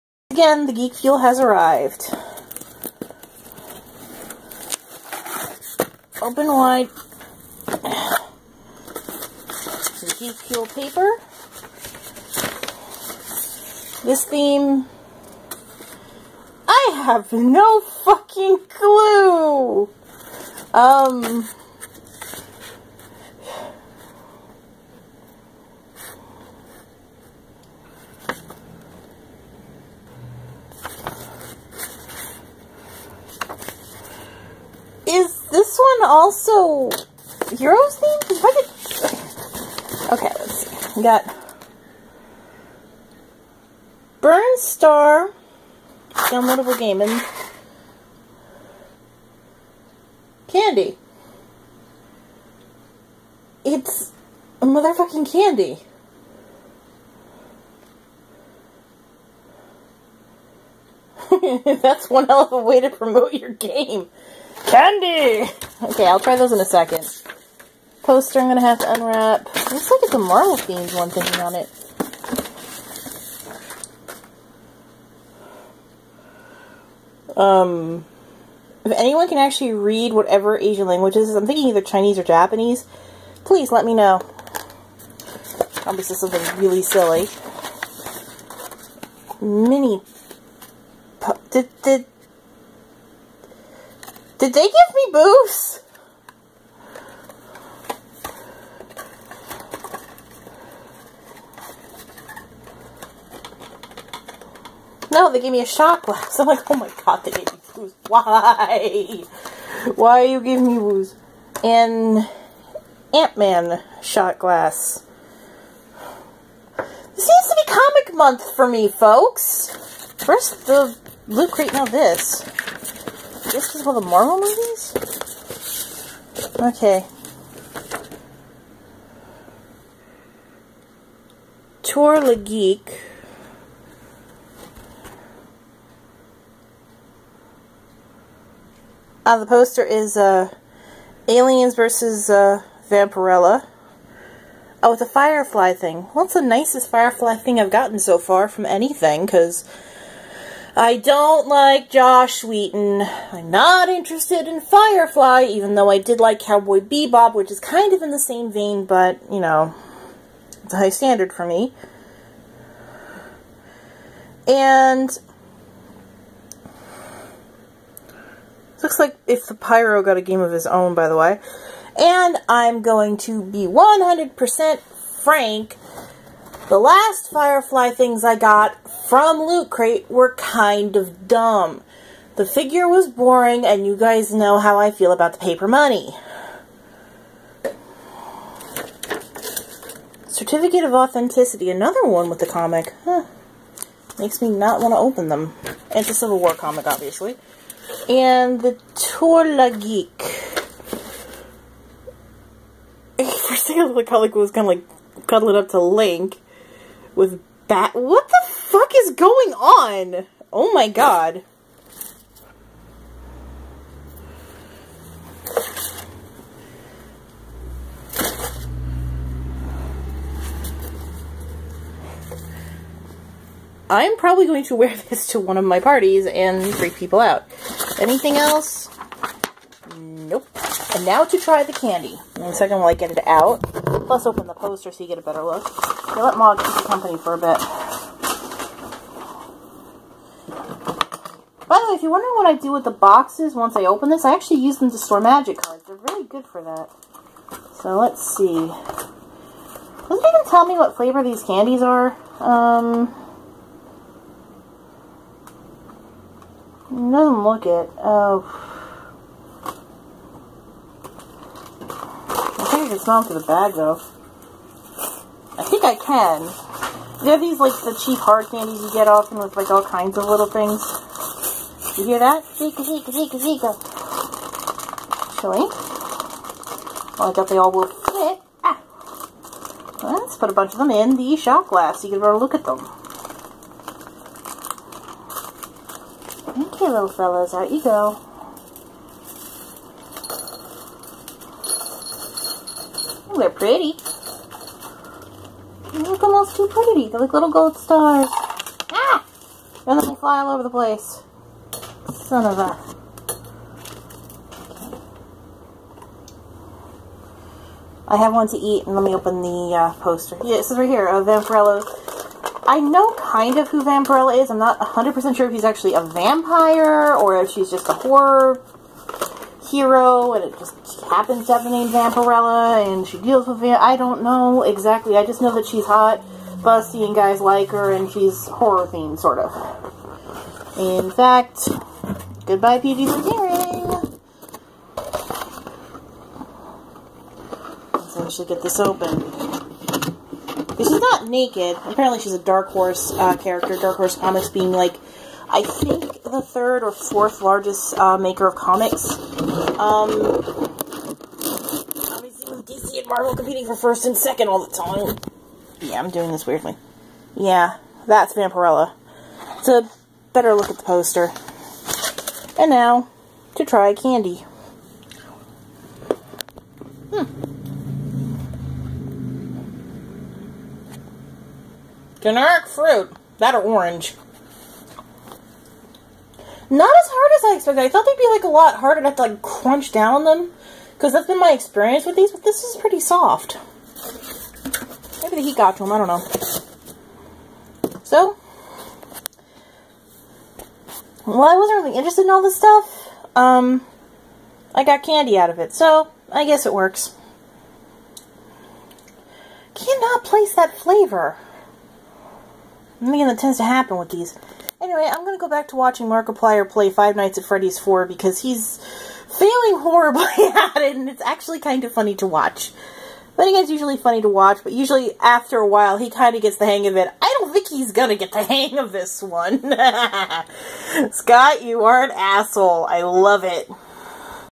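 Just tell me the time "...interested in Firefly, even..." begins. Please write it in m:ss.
2:33.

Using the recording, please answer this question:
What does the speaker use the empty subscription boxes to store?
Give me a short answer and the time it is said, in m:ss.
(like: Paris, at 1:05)
Magic cards, at 4:05.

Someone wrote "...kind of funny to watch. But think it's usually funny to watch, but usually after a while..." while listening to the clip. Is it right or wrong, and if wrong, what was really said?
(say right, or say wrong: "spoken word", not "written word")
right.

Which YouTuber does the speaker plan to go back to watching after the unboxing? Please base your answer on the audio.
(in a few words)
Markiplier.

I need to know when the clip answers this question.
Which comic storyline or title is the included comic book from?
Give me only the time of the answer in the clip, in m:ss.
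3:16.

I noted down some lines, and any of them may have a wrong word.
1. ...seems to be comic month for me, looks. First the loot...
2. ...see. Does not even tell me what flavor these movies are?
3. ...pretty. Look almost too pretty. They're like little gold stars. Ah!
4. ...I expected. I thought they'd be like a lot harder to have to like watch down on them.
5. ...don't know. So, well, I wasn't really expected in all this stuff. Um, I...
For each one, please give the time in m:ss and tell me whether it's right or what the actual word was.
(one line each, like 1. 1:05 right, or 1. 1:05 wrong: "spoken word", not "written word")
1. 1:57 wrong: "folks", not "looks"
2. 4:08 wrong: "candies", not "movies"
3. 4:53 right
4. 6:17 wrong: "crunch", not "watch"
5. 6:25 wrong: "interested", not "expected".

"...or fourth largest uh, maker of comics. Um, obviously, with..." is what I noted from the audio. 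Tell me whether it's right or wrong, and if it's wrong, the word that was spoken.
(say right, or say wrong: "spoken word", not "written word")
right.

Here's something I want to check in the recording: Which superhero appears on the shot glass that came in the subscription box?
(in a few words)
Ant-Man.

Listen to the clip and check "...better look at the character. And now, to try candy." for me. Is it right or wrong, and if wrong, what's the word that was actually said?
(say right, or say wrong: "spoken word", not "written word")
wrong: "poster", not "character".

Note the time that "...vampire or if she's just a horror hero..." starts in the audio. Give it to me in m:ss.
5:16.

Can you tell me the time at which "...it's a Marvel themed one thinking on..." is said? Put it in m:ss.
1:10.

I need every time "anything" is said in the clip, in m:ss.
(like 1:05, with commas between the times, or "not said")
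2:28, 3:47.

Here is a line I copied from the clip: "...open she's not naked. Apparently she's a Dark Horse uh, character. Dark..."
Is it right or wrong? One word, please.
right.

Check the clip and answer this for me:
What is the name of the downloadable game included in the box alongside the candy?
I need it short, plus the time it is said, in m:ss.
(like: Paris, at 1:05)
Burn Star, at 0:44.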